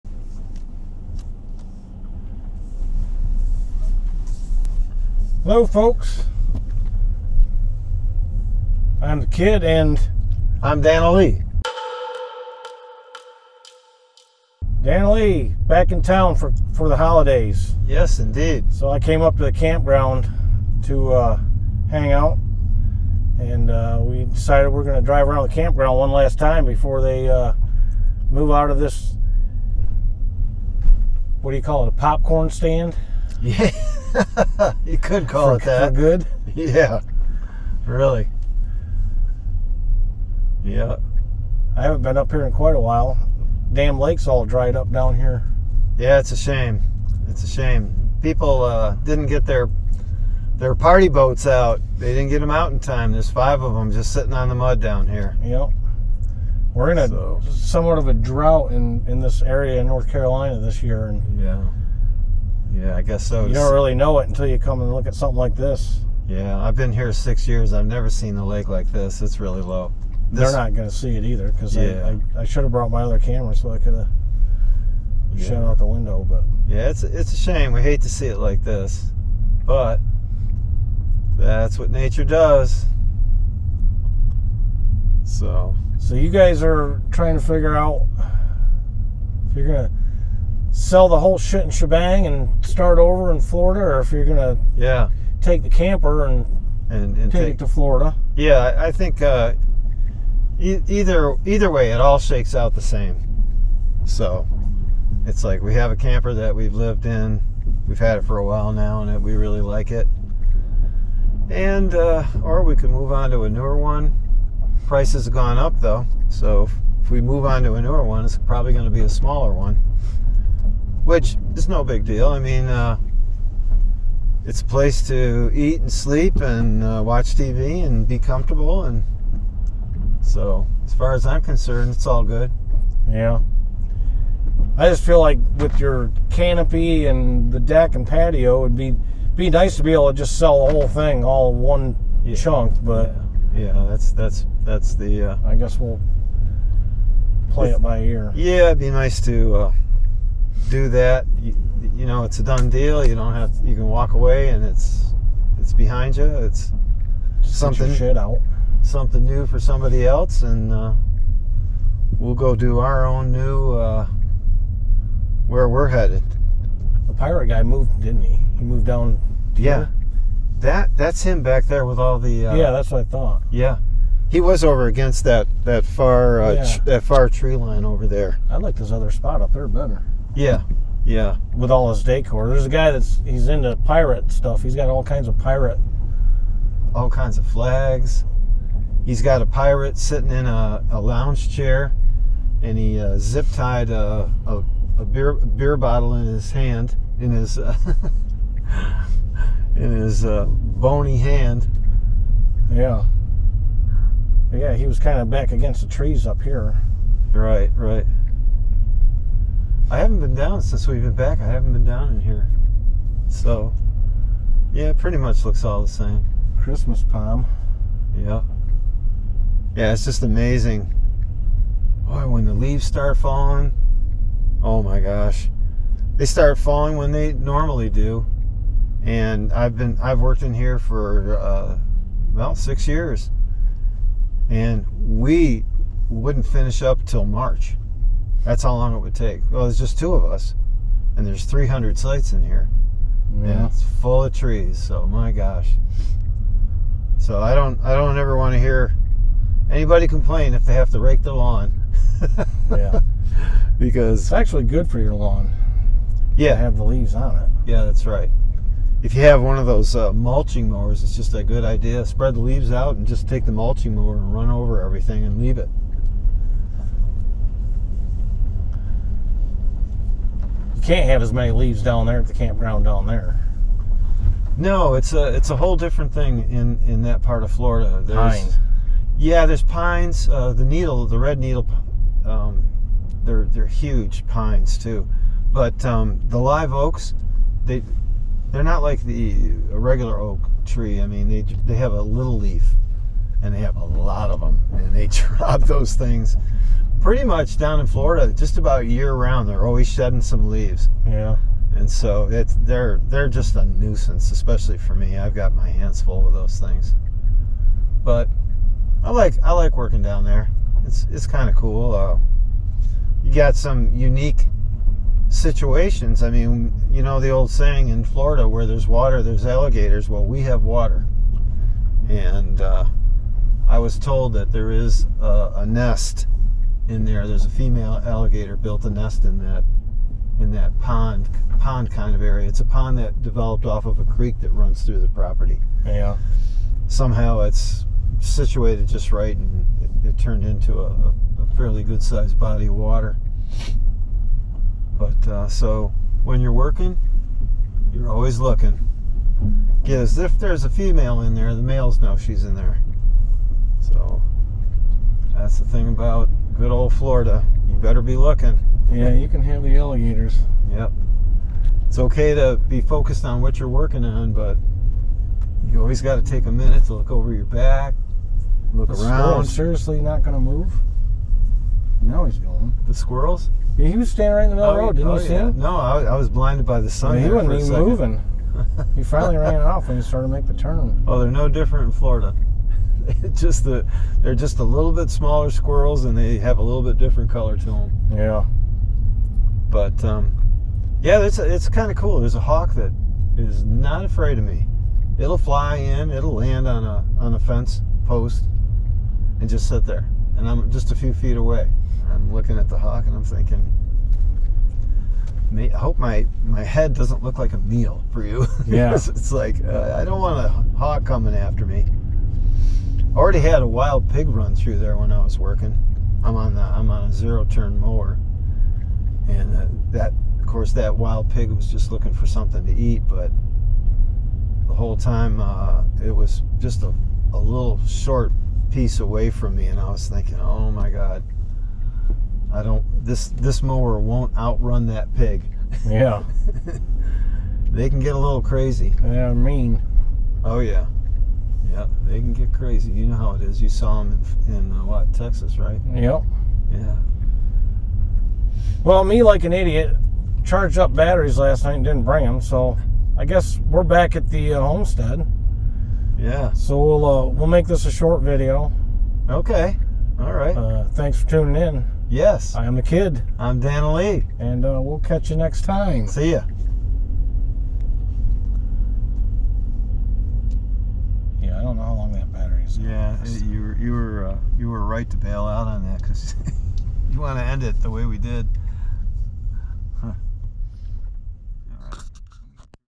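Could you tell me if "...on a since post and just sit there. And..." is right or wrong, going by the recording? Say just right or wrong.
wrong.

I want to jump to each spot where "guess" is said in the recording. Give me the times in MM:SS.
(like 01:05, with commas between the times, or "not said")
01:03, 02:25, 07:33.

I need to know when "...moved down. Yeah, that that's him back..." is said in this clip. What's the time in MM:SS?
02:48.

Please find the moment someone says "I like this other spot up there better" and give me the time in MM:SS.
02:58.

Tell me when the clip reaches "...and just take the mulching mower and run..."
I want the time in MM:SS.
04:22.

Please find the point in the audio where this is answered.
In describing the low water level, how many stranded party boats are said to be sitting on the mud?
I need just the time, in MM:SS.
00:53.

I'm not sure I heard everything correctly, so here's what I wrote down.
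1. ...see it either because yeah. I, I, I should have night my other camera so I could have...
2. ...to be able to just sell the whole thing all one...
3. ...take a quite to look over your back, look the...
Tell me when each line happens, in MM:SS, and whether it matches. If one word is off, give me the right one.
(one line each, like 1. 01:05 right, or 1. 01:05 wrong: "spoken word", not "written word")
1. 01:10 wrong: "brought", not "night"
2. 02:19 right
3. 06:06 wrong: "minute", not "quite".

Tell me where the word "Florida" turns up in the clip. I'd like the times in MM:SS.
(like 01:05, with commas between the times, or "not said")
01:33, 01:37, 04:37, 04:57, 05:18, 05:56, 06:21.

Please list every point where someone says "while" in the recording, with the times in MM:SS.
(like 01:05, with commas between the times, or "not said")
00:42, 01:48.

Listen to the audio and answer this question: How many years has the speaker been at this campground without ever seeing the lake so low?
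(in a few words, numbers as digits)
6.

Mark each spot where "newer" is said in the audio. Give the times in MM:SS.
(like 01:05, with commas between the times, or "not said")
01:53, 01:57.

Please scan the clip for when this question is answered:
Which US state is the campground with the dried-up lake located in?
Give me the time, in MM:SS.
00:59.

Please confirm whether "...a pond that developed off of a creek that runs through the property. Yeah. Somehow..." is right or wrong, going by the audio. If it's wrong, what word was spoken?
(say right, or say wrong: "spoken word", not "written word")
right.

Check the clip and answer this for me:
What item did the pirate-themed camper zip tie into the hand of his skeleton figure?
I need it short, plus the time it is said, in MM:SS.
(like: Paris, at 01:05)
A beer bottle, at 03:15.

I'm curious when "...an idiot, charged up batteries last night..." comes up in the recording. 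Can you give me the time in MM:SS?
07:29.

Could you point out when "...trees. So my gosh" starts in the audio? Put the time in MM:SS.
04:04.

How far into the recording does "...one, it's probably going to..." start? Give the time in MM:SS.
01:58.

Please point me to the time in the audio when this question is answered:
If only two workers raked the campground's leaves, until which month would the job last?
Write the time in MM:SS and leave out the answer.
03:57.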